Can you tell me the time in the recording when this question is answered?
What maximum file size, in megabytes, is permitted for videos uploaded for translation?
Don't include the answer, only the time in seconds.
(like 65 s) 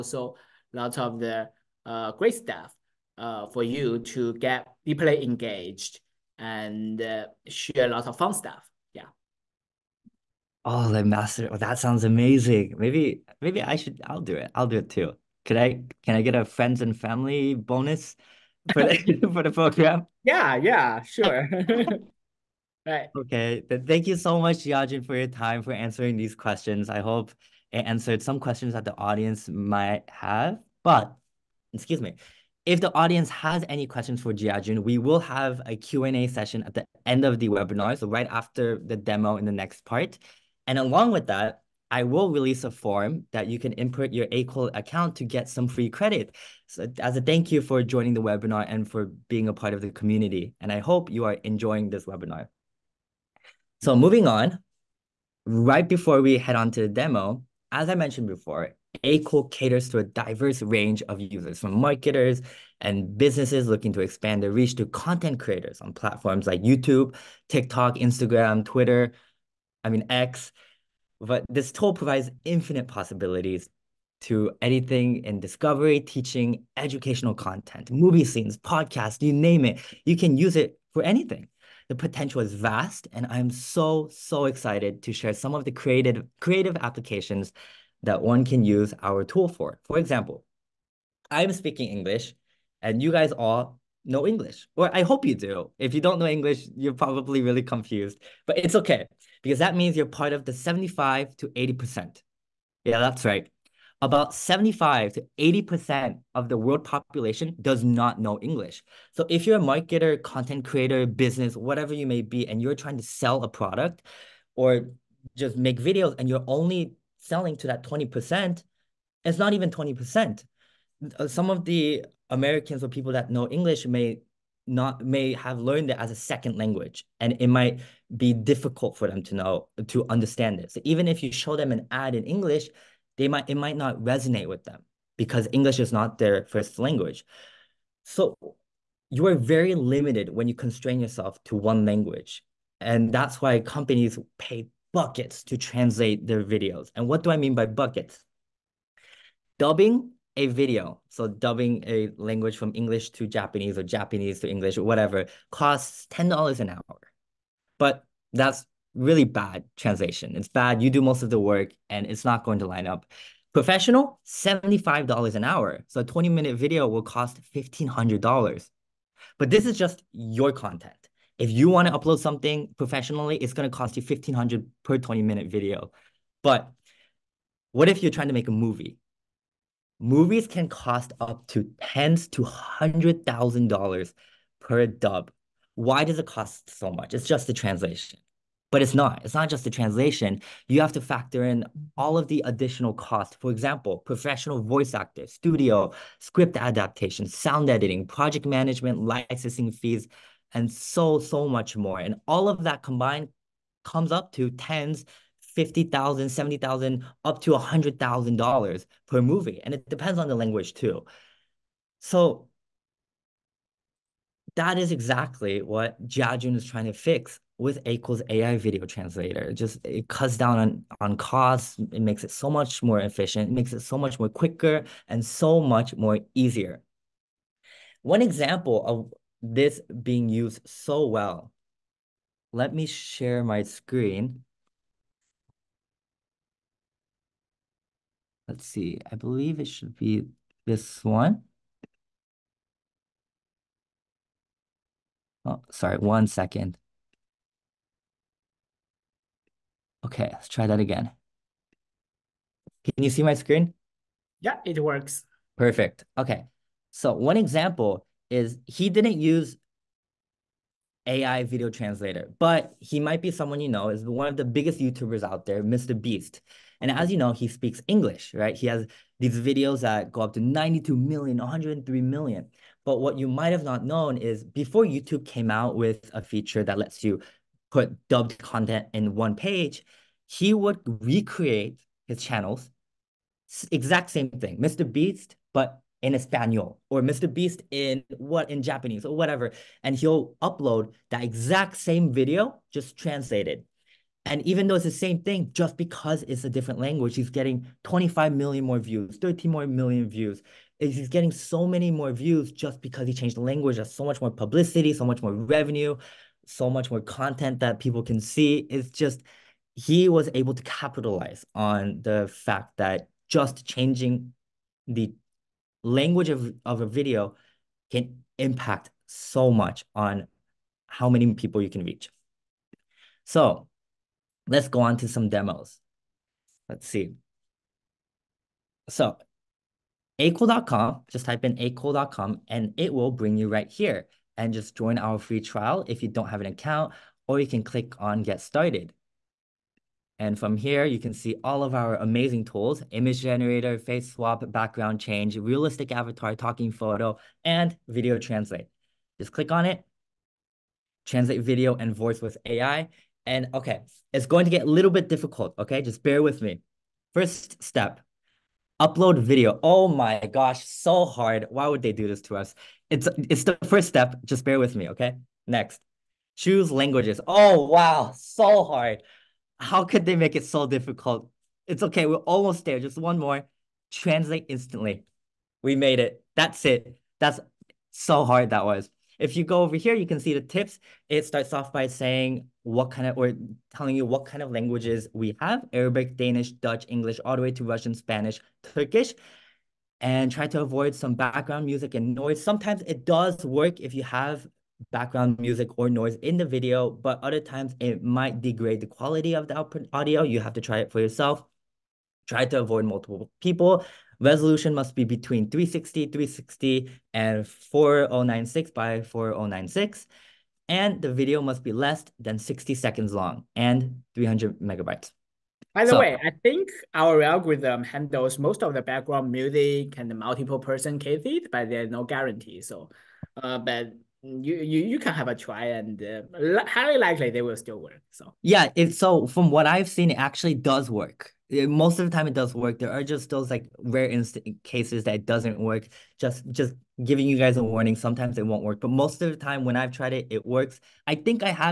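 414 s.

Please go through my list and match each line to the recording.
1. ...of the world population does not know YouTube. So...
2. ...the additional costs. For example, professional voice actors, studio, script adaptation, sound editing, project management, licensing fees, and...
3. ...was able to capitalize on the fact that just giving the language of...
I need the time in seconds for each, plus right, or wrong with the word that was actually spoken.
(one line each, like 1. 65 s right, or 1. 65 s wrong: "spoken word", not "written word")
1. 106 s wrong: "English", not "YouTube"
2. 192 s right
3. 310 s wrong: "changing", not "giving".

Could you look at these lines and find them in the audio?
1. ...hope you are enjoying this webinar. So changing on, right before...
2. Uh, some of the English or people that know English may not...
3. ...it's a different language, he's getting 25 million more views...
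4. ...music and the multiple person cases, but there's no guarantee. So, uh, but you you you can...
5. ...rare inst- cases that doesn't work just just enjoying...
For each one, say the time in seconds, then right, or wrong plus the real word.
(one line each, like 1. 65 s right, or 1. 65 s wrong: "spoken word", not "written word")
1. 50 s wrong: "moving", not "changing"
2. 121 s wrong: "Americans", not "English"
3. 296 s right
4. 419 s right
5. 433 s wrong: "giving", not "enjoying".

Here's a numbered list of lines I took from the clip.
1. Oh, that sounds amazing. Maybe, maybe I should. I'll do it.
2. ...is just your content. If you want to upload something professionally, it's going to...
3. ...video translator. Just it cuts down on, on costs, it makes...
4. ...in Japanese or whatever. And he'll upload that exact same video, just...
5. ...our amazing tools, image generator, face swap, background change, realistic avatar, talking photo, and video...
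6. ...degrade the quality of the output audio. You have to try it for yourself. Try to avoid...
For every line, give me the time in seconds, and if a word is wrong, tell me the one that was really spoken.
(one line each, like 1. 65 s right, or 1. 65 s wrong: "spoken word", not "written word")
1. 11 s right
2. 169 s right
3. 218 s right
4. 288 s right
5. 341 s right
6. 398 s right.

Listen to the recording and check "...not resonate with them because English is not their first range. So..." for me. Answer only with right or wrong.
wrong.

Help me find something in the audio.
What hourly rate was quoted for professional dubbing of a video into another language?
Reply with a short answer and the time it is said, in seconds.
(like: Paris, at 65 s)
$75, at 164 s.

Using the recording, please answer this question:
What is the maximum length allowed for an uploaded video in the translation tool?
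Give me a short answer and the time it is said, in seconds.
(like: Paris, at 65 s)
60 seconds, at 412 s.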